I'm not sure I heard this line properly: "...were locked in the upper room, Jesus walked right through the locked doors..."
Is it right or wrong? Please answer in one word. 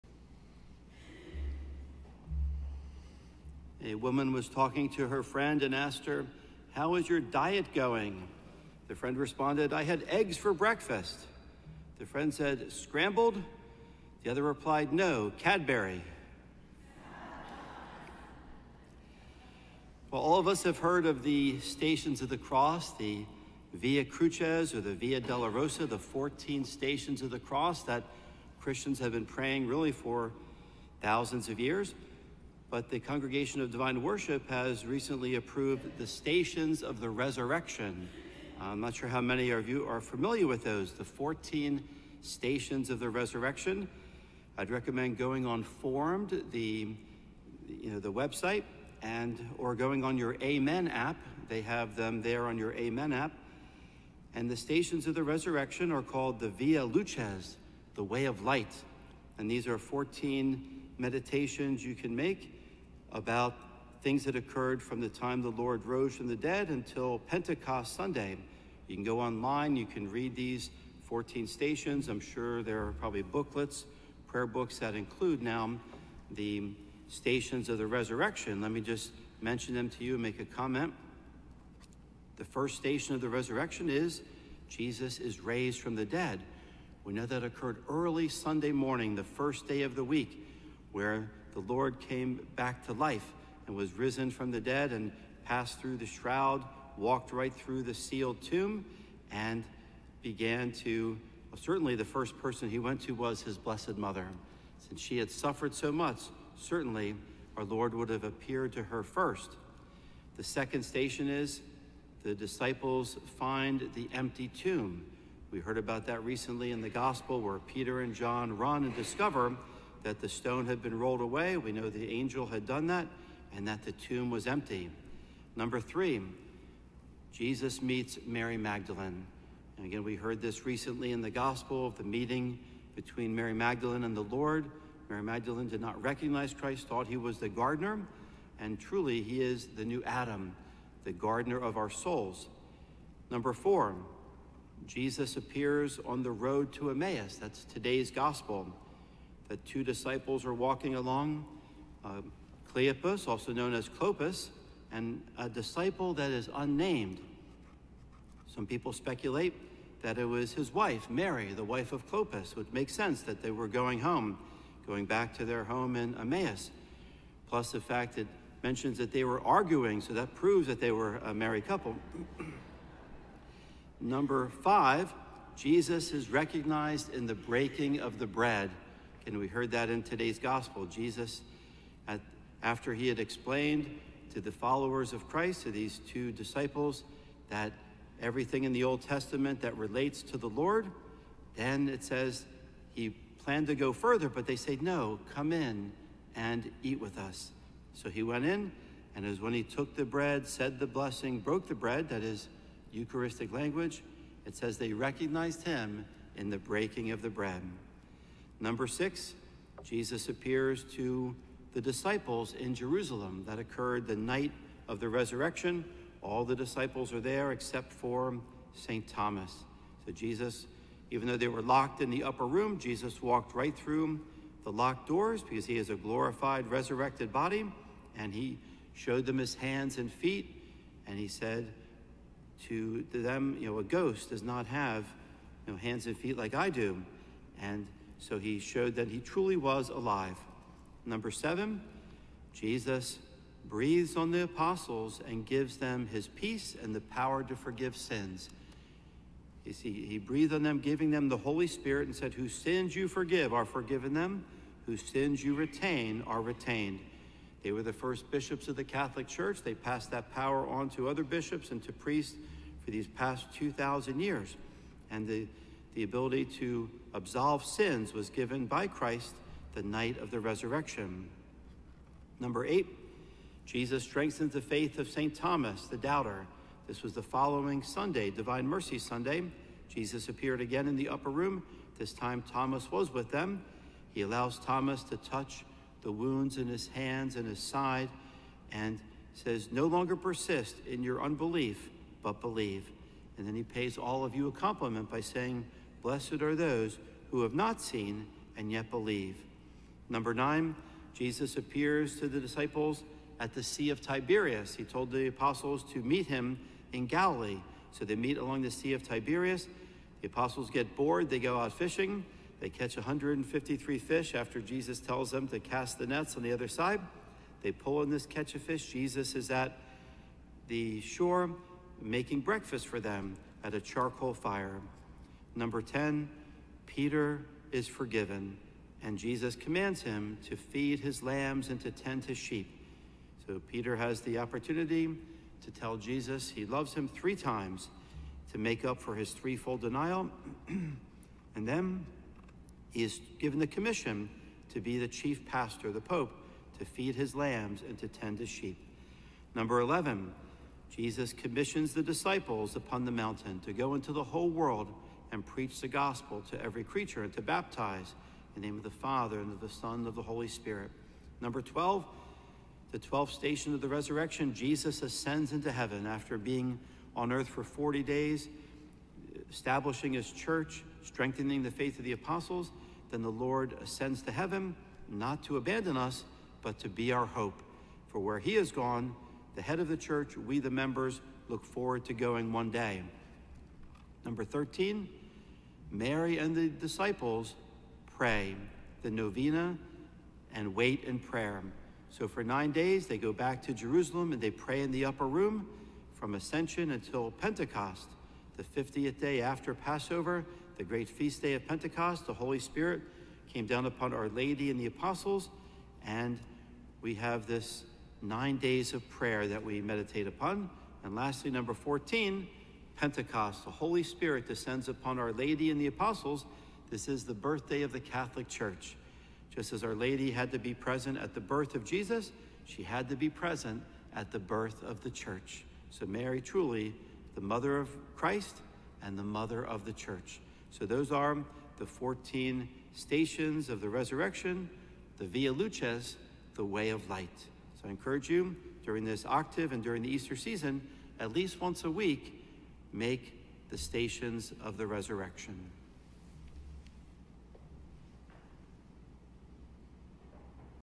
right.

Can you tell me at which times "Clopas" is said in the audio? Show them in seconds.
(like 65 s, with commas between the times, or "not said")
153 s, 162 s.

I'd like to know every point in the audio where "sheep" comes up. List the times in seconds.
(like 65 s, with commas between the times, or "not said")
332 s, 348 s.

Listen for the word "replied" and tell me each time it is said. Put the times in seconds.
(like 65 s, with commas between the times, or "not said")
14 s.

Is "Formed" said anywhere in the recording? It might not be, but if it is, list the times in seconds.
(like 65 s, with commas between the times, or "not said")
45 s.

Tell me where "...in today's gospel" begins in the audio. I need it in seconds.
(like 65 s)
179 s.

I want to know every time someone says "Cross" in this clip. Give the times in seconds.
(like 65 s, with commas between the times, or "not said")
22 s, 27 s.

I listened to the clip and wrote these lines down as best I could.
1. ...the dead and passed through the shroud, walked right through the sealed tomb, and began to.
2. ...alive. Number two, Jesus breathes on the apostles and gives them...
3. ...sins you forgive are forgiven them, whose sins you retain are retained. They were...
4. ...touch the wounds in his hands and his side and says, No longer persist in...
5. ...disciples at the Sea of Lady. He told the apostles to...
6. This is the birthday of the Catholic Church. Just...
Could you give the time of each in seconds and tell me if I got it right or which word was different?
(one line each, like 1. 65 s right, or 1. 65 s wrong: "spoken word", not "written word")
1. 94 s right
2. 239 s wrong: "seven", not "two"
3. 252 s right
4. 285 s right
5. 302 s wrong: "Tiberias", not "Lady"
6. 416 s right.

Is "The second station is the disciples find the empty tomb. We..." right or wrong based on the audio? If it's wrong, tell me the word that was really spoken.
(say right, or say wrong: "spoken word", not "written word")
right.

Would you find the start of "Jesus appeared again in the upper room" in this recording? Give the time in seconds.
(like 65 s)
279 s.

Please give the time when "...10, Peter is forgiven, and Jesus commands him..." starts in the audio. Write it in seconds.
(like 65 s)
325 s.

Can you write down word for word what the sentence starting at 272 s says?
Number eight, Jesus strengthens the faith of St.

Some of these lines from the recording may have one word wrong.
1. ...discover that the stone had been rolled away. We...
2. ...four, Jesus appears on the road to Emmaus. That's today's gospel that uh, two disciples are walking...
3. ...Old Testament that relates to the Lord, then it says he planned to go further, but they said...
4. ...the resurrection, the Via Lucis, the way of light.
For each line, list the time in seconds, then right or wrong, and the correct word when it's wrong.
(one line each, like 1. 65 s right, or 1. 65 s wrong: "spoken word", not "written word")
1. 118 s right
2. 143 s right
3. 188 s right
4. 433 s right.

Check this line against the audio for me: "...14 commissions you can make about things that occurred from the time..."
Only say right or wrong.
wrong.